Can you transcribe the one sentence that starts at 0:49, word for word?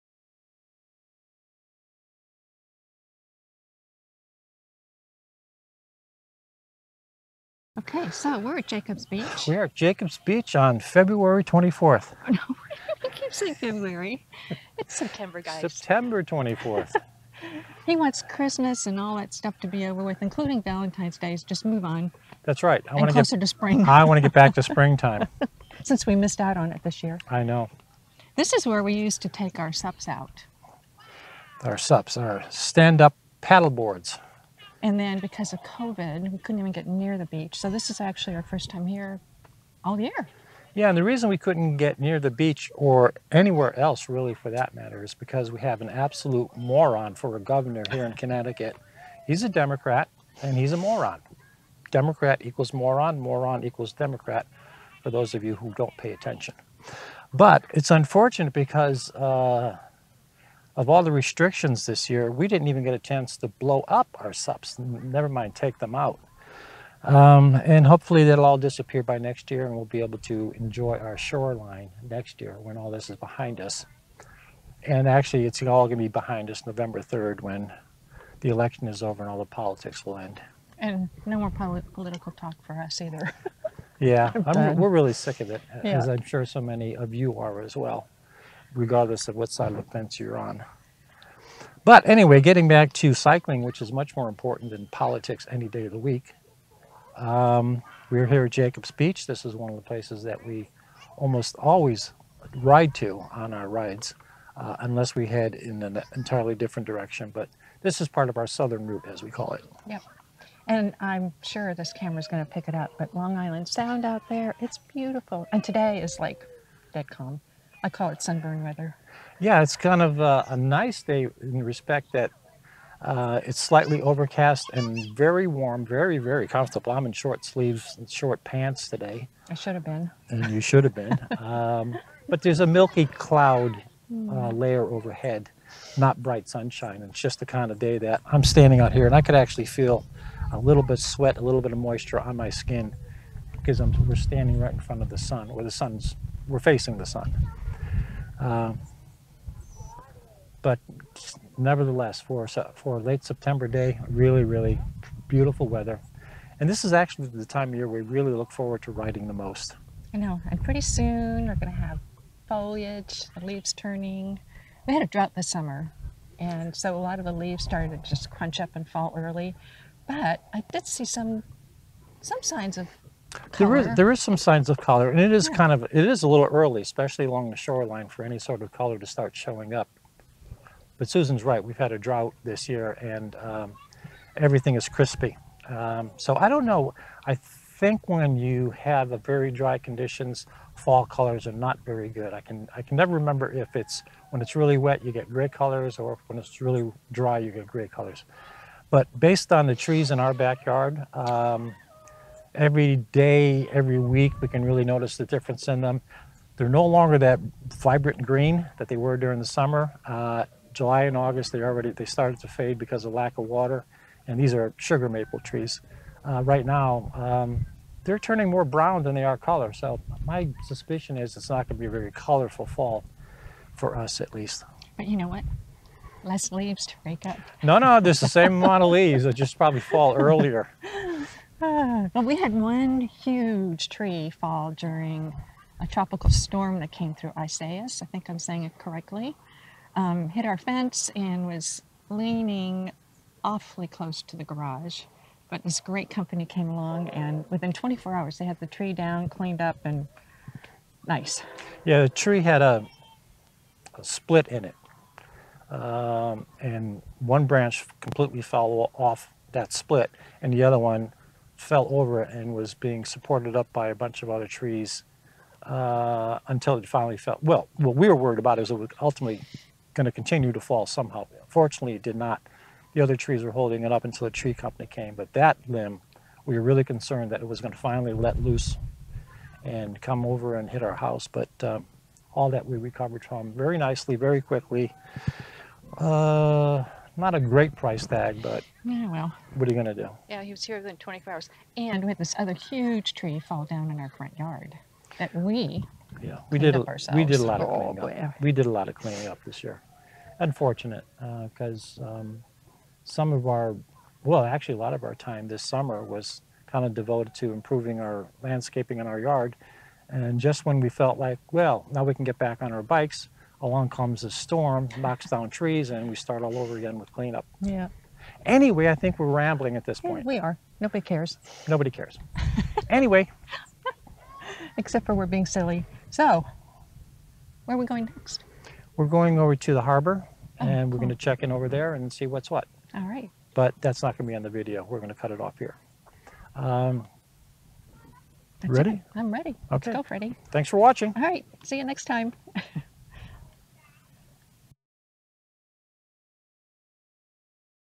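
He's a Democrat and he's a moron.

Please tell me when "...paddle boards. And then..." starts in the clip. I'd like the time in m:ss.
0:33.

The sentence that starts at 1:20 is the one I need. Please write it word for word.
And no more poli political talk for us either.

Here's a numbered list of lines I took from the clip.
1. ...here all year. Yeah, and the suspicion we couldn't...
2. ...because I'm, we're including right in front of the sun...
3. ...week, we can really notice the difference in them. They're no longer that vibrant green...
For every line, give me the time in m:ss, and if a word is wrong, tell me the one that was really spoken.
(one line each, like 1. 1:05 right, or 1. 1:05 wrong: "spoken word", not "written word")
1. 0:38 wrong: "reason", not "suspicion"
2. 2:23 wrong: "standing", not "including"
3. 3:23 right.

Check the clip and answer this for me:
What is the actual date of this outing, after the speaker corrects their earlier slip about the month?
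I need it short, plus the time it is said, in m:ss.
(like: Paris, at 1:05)
September 24th, at 0:15.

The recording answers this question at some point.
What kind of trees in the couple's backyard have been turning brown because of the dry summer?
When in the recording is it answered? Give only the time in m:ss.
3:34.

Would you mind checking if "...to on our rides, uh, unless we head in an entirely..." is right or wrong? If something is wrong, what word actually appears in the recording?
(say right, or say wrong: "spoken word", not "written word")
right.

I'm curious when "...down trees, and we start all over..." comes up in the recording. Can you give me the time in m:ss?
5:15.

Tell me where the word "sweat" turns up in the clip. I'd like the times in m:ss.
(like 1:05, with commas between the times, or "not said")
2:20.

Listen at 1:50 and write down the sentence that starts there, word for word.
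And I'm sure this camera's going to pick it up, but Long Island Sound out there, it's beautiful.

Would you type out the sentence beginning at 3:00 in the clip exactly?
But Susan's right; we've had a drought this year, and um, everything is crispy.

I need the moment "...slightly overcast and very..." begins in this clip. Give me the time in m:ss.
2:03.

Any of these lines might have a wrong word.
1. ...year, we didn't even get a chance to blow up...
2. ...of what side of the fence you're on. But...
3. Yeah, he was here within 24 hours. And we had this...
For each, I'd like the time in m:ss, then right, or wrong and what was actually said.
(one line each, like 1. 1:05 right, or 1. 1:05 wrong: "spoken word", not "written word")
1. 1:02 right
2. 1:29 right
3. 4:50 right.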